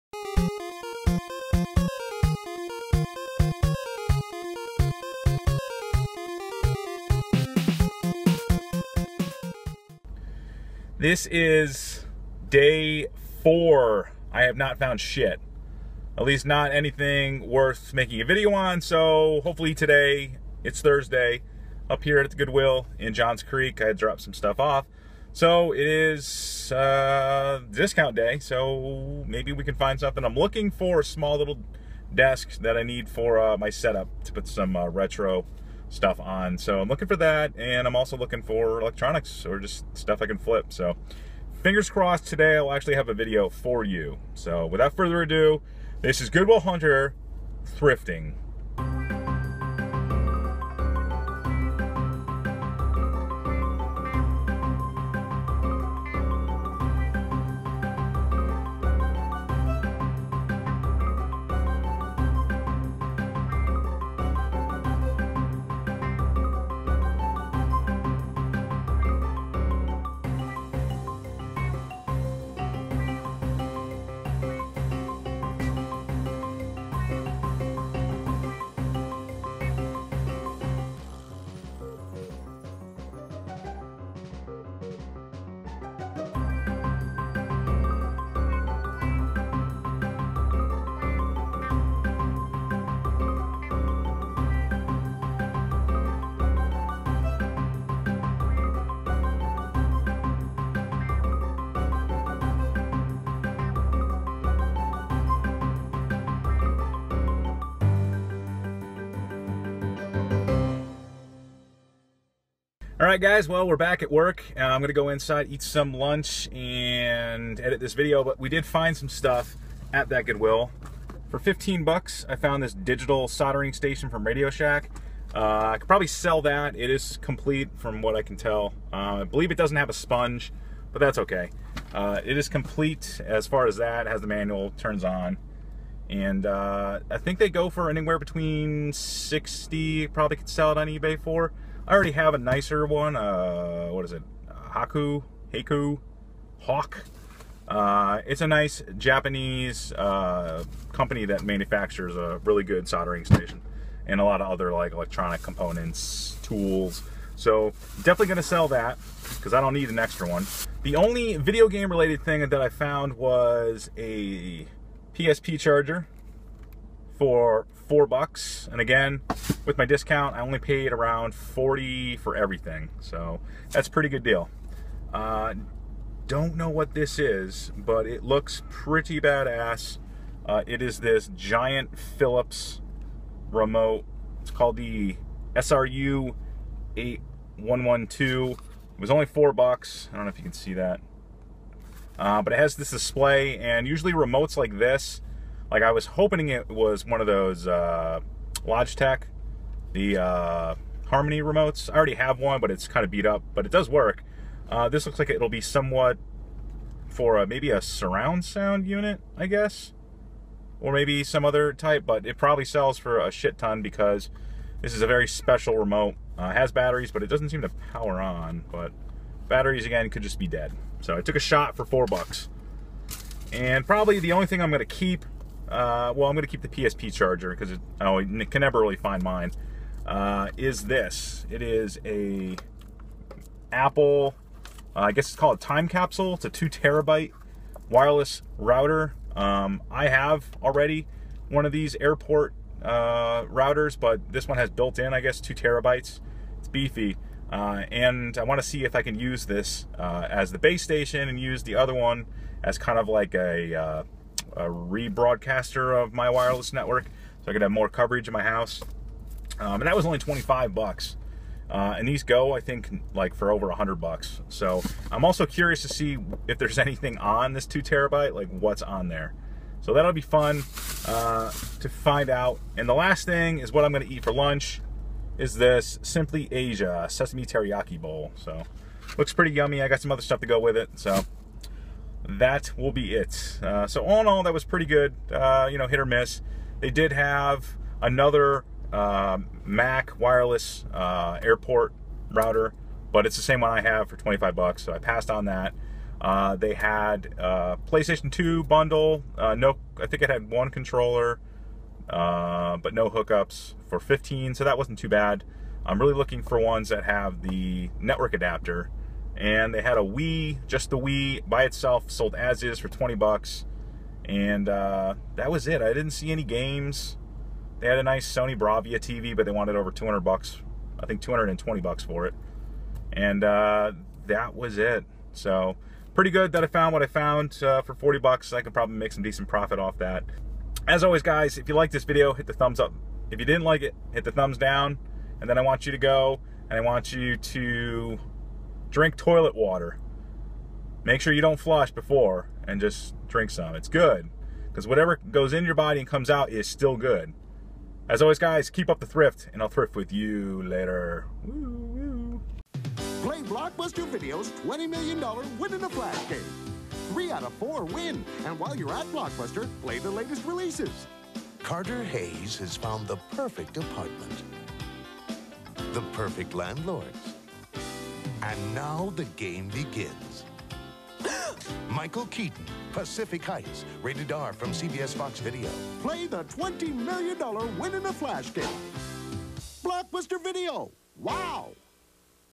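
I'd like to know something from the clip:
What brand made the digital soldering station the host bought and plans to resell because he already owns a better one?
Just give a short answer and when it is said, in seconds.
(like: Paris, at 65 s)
Radio Shack, at 124 s.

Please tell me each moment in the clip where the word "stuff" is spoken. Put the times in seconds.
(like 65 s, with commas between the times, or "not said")
24 s, 35 s, 39 s, 119 s, 280 s.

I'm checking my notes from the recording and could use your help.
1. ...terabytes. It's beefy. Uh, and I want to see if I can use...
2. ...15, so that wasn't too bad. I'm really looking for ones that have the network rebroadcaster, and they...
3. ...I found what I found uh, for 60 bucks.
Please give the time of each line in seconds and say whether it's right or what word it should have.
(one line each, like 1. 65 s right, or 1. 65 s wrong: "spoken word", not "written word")
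1. 245 s right
2. 303 s wrong: "adapter", not "rebroadcaster"
3. 326 s wrong: "40", not "60".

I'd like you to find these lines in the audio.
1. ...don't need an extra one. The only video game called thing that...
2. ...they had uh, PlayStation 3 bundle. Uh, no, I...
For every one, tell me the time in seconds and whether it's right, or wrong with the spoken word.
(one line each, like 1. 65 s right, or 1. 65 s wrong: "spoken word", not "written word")
1. 159 s wrong: "related", not "called"
2. 296 s wrong: "2", not "3".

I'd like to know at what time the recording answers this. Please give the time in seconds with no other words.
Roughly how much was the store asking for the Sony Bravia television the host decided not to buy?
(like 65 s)
321 s.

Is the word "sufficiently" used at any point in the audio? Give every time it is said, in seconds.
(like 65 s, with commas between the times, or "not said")
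not said.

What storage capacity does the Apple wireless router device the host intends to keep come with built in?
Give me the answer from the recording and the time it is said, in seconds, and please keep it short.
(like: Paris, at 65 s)
2 terabytes, at 236 s.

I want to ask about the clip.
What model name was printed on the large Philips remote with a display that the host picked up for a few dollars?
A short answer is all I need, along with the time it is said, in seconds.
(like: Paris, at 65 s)
SRU 8112, at 185 s.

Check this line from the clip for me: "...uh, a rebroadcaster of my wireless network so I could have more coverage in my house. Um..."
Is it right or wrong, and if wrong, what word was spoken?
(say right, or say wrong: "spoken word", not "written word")
right.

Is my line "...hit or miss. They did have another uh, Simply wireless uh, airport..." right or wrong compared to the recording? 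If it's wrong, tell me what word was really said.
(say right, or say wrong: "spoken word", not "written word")
wrong: "Mac", not "Simply".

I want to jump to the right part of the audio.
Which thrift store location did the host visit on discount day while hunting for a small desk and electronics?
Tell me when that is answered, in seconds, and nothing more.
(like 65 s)
23 s.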